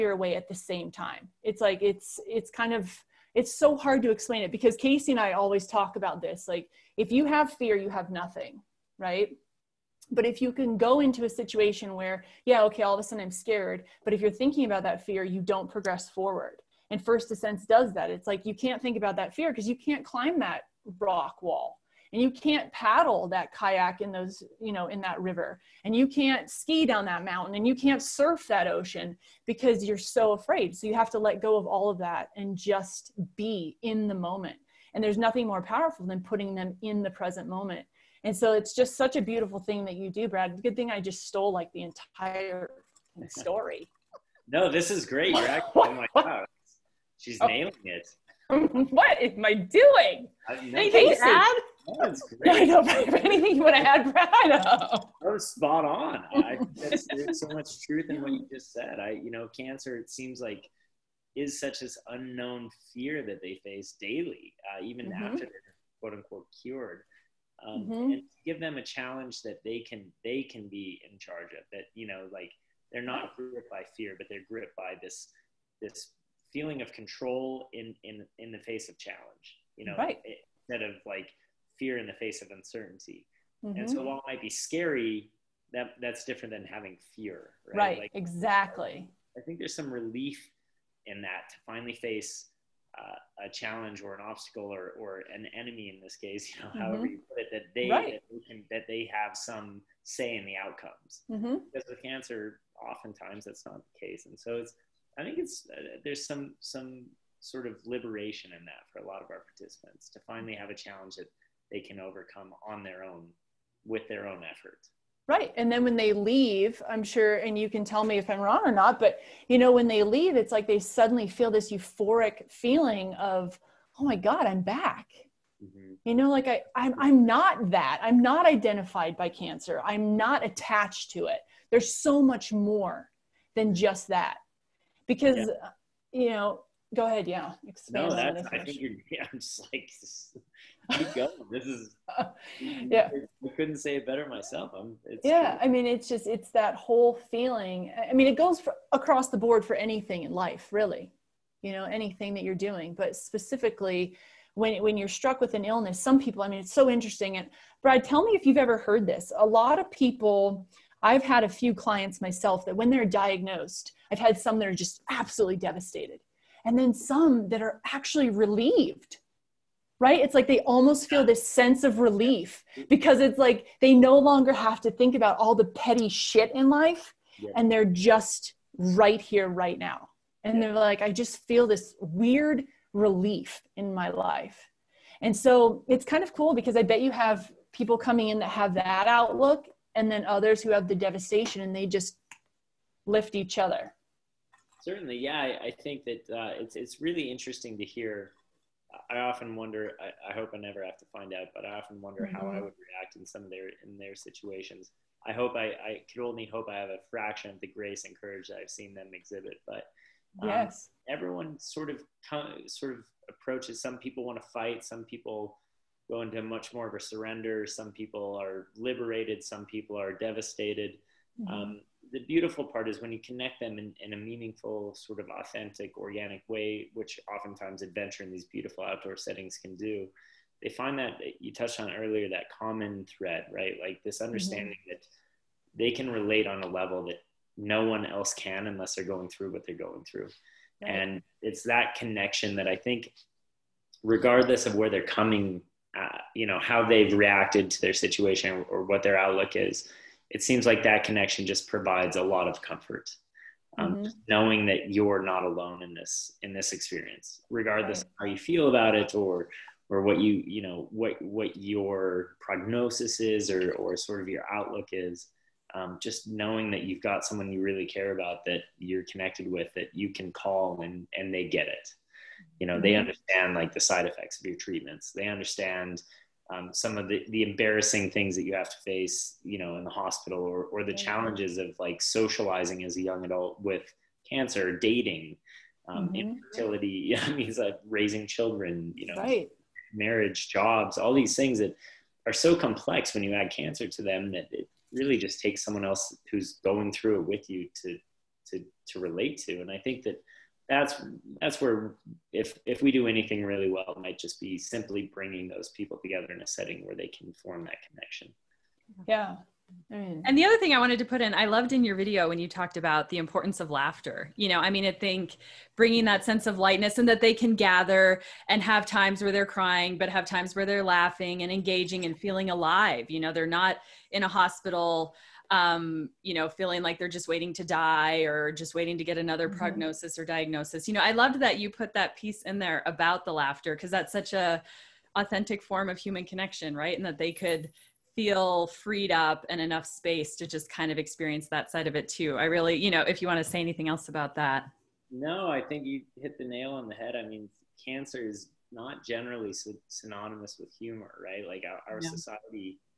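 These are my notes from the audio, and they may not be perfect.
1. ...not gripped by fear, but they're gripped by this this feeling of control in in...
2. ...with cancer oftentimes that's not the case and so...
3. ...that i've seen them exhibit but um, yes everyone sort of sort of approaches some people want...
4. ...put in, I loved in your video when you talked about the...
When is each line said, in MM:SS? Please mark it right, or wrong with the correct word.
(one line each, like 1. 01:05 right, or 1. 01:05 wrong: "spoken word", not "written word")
1. 01:13 right
2. 01:41 right
3. 03:28 right
4. 05:11 right.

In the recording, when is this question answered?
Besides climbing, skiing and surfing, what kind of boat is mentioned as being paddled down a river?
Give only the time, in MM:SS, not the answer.
00:23.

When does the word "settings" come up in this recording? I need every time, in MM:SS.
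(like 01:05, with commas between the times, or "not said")
03:49, 05:06.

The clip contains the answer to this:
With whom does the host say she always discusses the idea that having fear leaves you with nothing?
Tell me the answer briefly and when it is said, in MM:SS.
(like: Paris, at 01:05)
Casey, at 00:04.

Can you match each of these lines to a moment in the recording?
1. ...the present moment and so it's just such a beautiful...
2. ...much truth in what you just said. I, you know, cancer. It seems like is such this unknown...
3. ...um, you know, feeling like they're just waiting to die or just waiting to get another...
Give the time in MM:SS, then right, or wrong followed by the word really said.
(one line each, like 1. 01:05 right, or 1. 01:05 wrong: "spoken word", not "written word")
1. 00:37 right
2. 00:57 right
3. 05:25 right.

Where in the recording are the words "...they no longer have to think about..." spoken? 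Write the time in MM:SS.
02:53.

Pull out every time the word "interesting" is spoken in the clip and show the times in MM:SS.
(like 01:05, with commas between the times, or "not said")
02:36, 03:17.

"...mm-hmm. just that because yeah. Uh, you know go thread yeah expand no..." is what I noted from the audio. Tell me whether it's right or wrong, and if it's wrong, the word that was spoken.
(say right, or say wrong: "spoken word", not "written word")
wrong: "ahead", not "thread".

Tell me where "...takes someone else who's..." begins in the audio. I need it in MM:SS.
04:55.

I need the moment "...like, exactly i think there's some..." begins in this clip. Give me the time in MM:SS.
01:27.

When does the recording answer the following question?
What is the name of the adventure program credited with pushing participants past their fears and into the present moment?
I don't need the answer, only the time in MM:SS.
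00:17.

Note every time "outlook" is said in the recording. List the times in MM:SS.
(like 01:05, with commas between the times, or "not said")
03:09, 04:09, 04:24.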